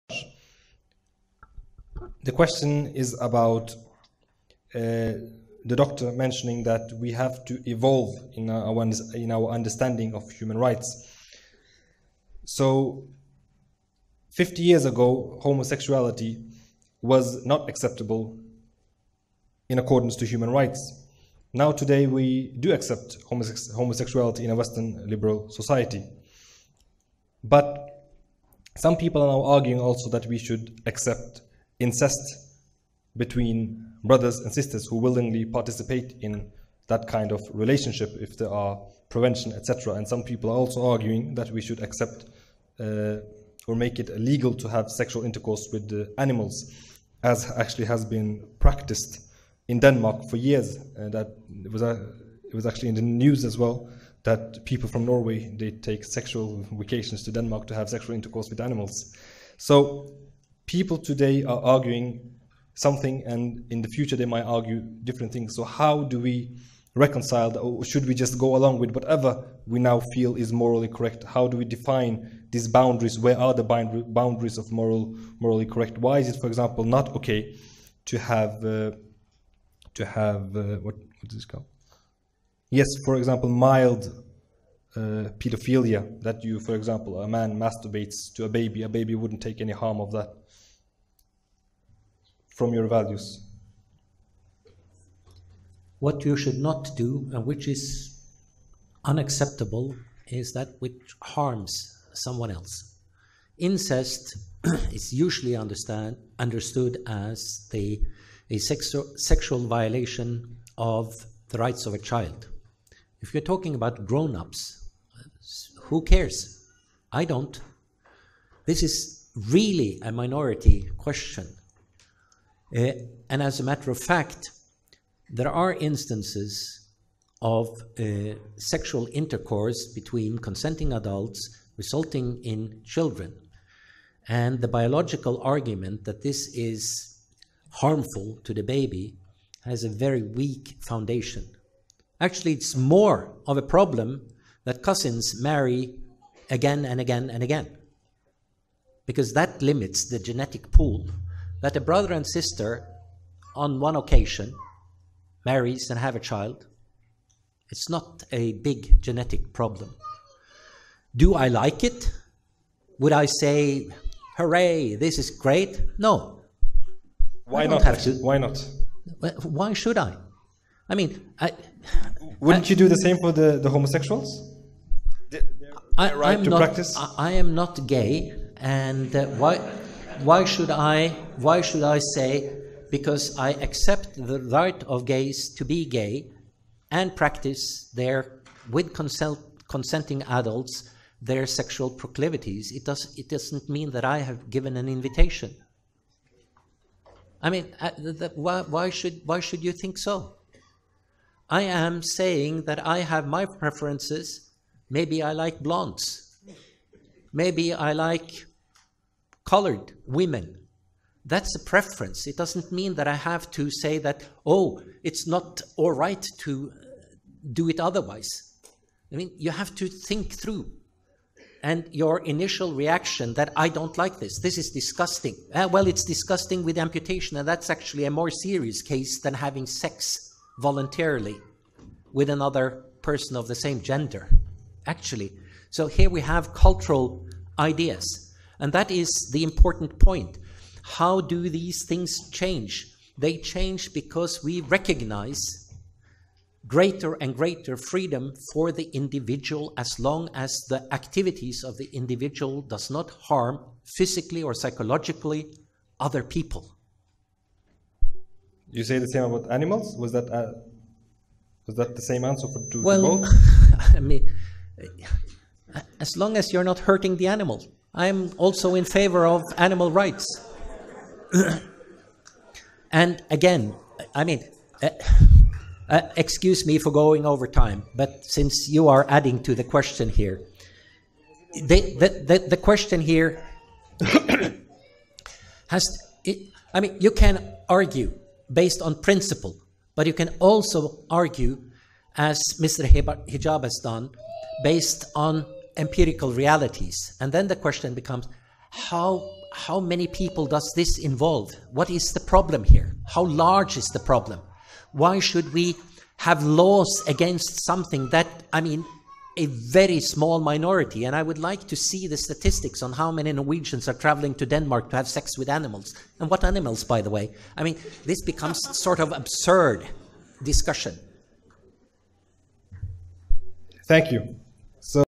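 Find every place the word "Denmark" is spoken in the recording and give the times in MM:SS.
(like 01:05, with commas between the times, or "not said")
00:49, 00:57, 05:14.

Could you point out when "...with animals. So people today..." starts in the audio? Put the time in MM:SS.
00:58.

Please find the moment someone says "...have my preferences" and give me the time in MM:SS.
03:22.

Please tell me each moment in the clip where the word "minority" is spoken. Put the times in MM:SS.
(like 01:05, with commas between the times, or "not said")
02:00, 05:10.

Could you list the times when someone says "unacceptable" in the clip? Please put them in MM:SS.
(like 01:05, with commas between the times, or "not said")
01:39.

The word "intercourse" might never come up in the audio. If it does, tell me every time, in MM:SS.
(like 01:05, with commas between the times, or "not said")
00:45, 00:58, 02:09.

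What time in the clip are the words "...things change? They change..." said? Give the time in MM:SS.
04:01.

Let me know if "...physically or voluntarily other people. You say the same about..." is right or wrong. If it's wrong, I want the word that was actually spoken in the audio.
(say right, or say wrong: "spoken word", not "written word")
wrong: "psychologically", not "voluntarily".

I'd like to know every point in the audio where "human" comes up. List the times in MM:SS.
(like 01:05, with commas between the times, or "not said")
00:10, 00:20.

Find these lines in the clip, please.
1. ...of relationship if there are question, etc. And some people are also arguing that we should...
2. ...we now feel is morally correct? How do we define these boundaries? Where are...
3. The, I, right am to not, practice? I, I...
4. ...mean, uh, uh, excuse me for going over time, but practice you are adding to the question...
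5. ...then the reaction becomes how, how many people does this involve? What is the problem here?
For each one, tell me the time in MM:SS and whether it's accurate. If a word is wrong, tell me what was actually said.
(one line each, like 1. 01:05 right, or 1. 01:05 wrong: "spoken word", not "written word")
1. 00:37 wrong: "prevention", not "question"
2. 01:09 right
3. 02:55 right
4. 04:34 wrong: "since", not "practice"
5. 04:57 wrong: "question", not "reaction".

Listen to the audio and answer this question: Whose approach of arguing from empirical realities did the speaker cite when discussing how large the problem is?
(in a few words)
Mr. Hijab.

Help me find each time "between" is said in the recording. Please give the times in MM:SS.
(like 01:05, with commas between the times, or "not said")
00:33, 02:09.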